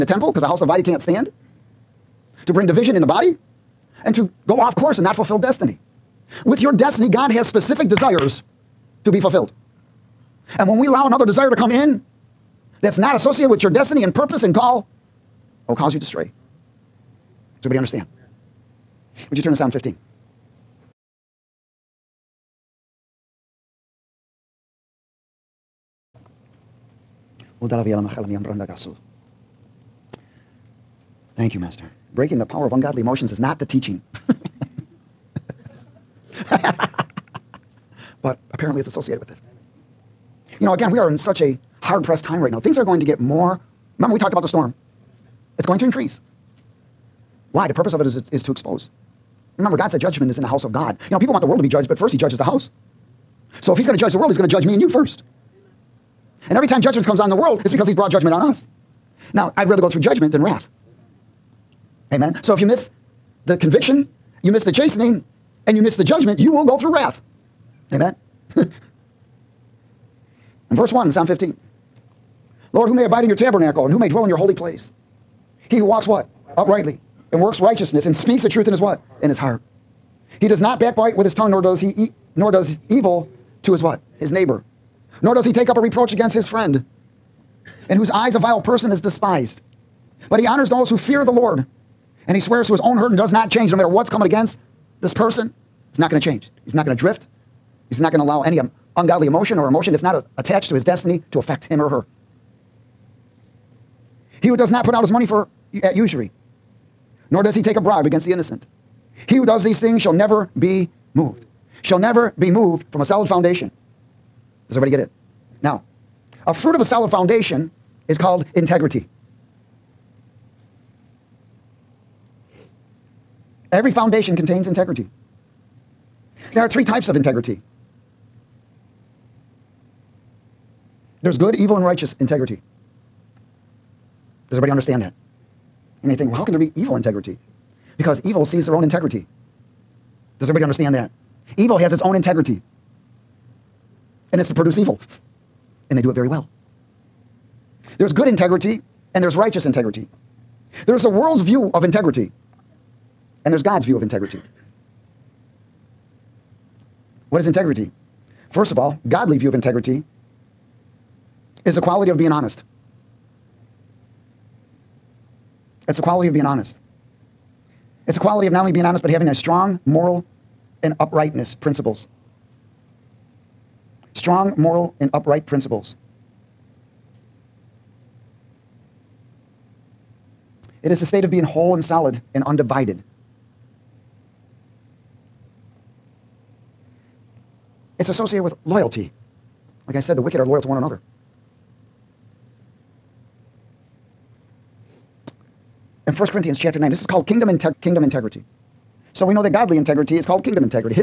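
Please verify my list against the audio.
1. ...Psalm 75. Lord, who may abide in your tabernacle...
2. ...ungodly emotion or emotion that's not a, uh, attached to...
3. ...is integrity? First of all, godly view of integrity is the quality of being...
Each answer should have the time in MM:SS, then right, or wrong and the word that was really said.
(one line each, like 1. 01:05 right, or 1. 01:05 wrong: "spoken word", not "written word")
1. 01:11 wrong: "15", not "75"
2. 01:38 right
3. 02:37 right.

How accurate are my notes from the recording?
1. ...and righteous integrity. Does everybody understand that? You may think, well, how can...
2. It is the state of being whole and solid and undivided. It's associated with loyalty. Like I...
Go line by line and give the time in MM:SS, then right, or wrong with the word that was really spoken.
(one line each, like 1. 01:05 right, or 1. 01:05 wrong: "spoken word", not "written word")
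1. 02:11 right
2. 03:00 right.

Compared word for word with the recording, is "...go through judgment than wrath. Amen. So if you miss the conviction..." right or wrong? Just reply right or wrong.
right.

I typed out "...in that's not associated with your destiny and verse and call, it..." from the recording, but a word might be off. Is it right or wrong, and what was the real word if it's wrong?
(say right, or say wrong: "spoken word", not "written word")
wrong: "purpose", not "verse".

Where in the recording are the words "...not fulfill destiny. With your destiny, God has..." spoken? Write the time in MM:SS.
00:05.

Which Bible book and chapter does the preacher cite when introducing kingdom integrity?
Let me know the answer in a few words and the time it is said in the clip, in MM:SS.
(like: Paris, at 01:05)
1 Corinthians 9, at 03:16.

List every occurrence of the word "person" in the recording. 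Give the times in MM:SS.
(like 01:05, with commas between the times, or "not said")
01:28, 01:35.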